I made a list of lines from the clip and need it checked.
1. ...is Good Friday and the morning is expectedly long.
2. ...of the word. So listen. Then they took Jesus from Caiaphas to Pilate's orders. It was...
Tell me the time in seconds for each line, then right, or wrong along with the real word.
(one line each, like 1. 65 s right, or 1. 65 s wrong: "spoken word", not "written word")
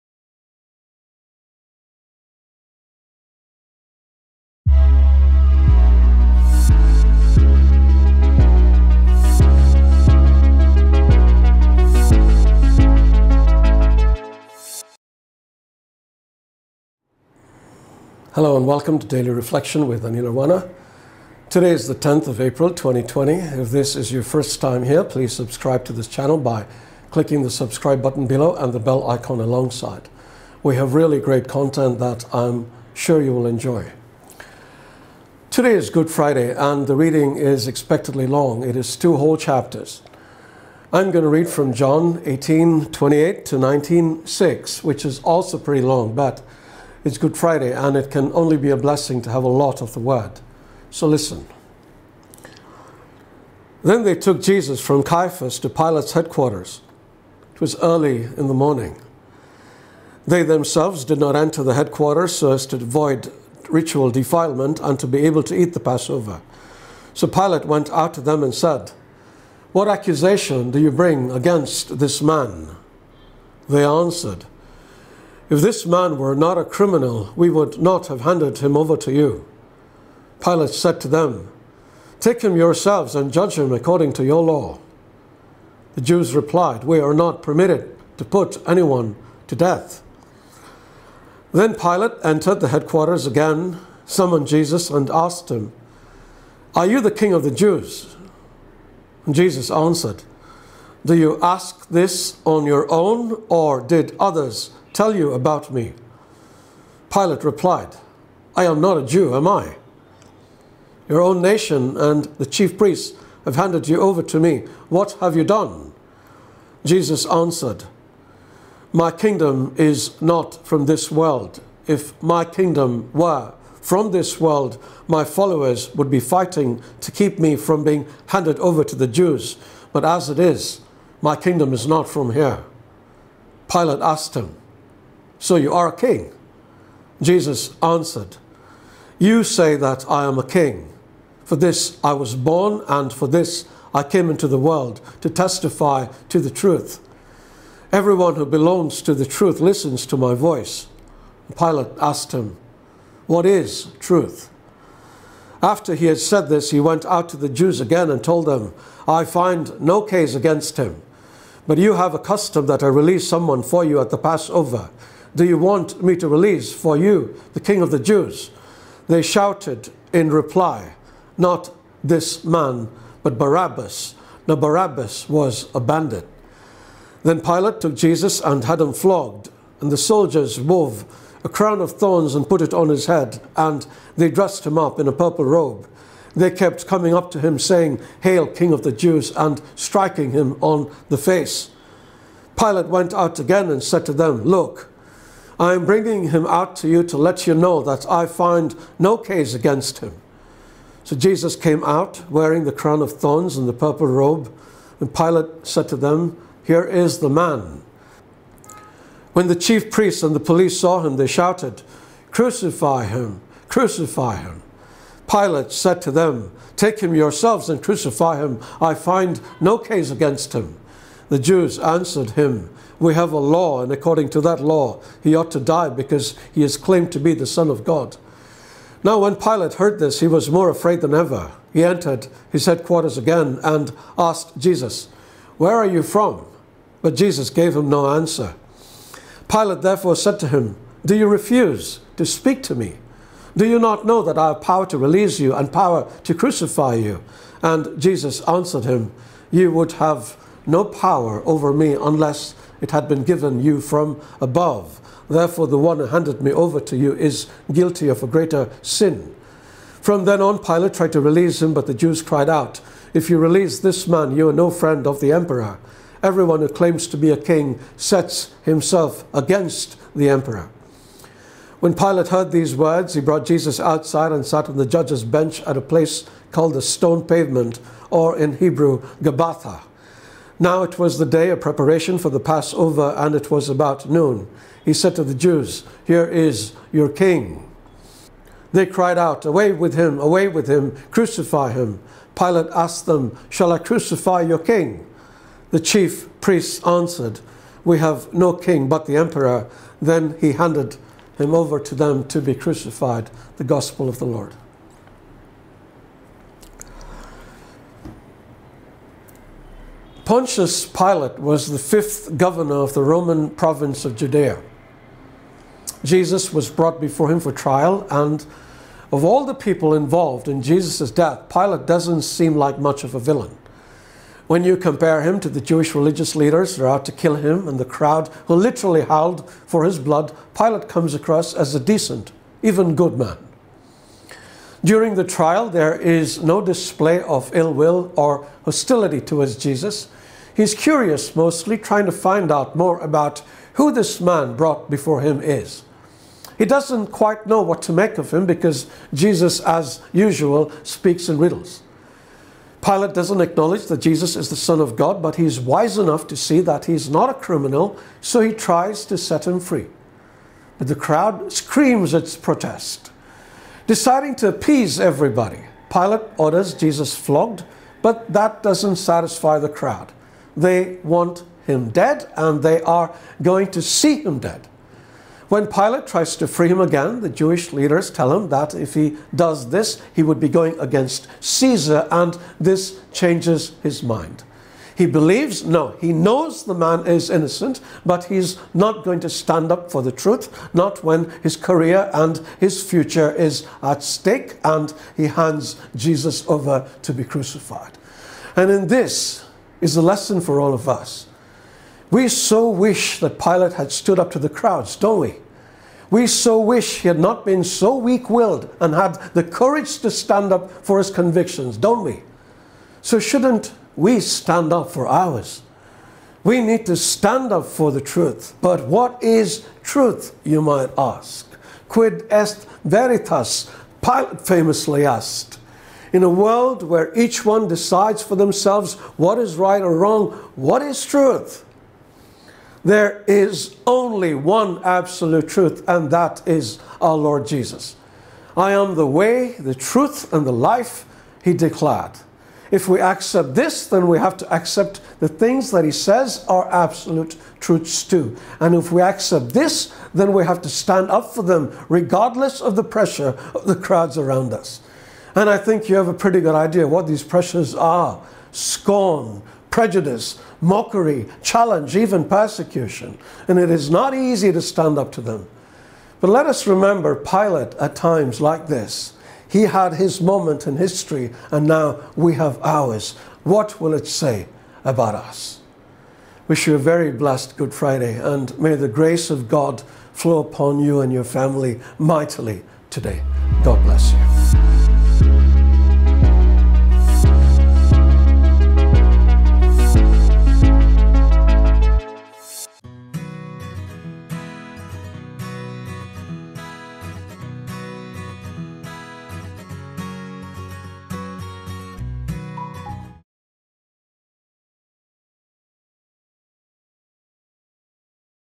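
1. 35 s wrong: "reading", not "morning"
2. 49 s wrong: "headquarters", not "orders".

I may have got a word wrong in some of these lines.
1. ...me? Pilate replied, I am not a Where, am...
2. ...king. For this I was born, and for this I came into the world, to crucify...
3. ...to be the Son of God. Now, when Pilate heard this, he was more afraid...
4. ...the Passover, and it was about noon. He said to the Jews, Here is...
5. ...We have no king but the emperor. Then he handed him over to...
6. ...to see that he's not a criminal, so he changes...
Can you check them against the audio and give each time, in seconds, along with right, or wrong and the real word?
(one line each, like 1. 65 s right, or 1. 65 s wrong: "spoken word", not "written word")
1. 105 s wrong: "Jew", not "Where"
2. 140 s wrong: "testify", not "crucify"
3. 227 s right
4. 282 s right
5. 297 s right
6. 356 s wrong: "tries", not "changes".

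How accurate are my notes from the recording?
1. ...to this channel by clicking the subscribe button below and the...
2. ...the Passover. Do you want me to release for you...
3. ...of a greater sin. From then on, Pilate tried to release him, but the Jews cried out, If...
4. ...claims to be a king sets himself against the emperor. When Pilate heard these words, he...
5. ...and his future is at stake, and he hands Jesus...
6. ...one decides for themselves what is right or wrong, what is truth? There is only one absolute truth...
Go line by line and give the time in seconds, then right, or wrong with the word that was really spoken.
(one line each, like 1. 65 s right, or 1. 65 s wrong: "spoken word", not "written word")
1. 25 s right
2. 164 s right
3. 258 s right
4. 266 s right
5. 392 s right
6. 427 s right.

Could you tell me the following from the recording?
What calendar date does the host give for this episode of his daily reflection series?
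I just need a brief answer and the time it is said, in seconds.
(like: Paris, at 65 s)
10th of April 2020, at 21 s.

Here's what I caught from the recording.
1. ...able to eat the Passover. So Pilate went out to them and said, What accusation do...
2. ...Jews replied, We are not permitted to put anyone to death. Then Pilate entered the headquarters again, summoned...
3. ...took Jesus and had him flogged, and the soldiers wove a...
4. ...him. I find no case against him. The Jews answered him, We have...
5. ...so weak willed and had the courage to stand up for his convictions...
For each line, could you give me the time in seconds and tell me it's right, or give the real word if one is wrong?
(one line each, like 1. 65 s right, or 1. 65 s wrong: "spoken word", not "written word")
1. 65 s right
2. 86 s right
3. 177 s right
4. 218 s right
5. 407 s right.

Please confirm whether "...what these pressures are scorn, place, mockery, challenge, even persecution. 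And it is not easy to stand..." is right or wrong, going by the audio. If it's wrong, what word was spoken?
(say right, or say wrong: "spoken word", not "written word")
wrong: "prejudice", not "place".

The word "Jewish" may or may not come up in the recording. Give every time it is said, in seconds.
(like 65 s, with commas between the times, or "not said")
325 s, 377 s.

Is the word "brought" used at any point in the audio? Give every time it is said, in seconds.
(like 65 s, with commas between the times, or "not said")
273 s, 316 s, 344 s.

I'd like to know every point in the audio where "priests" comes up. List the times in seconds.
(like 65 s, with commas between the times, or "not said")
112 s, 209 s, 296 s.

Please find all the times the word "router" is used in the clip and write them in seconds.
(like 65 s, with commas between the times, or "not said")
not said.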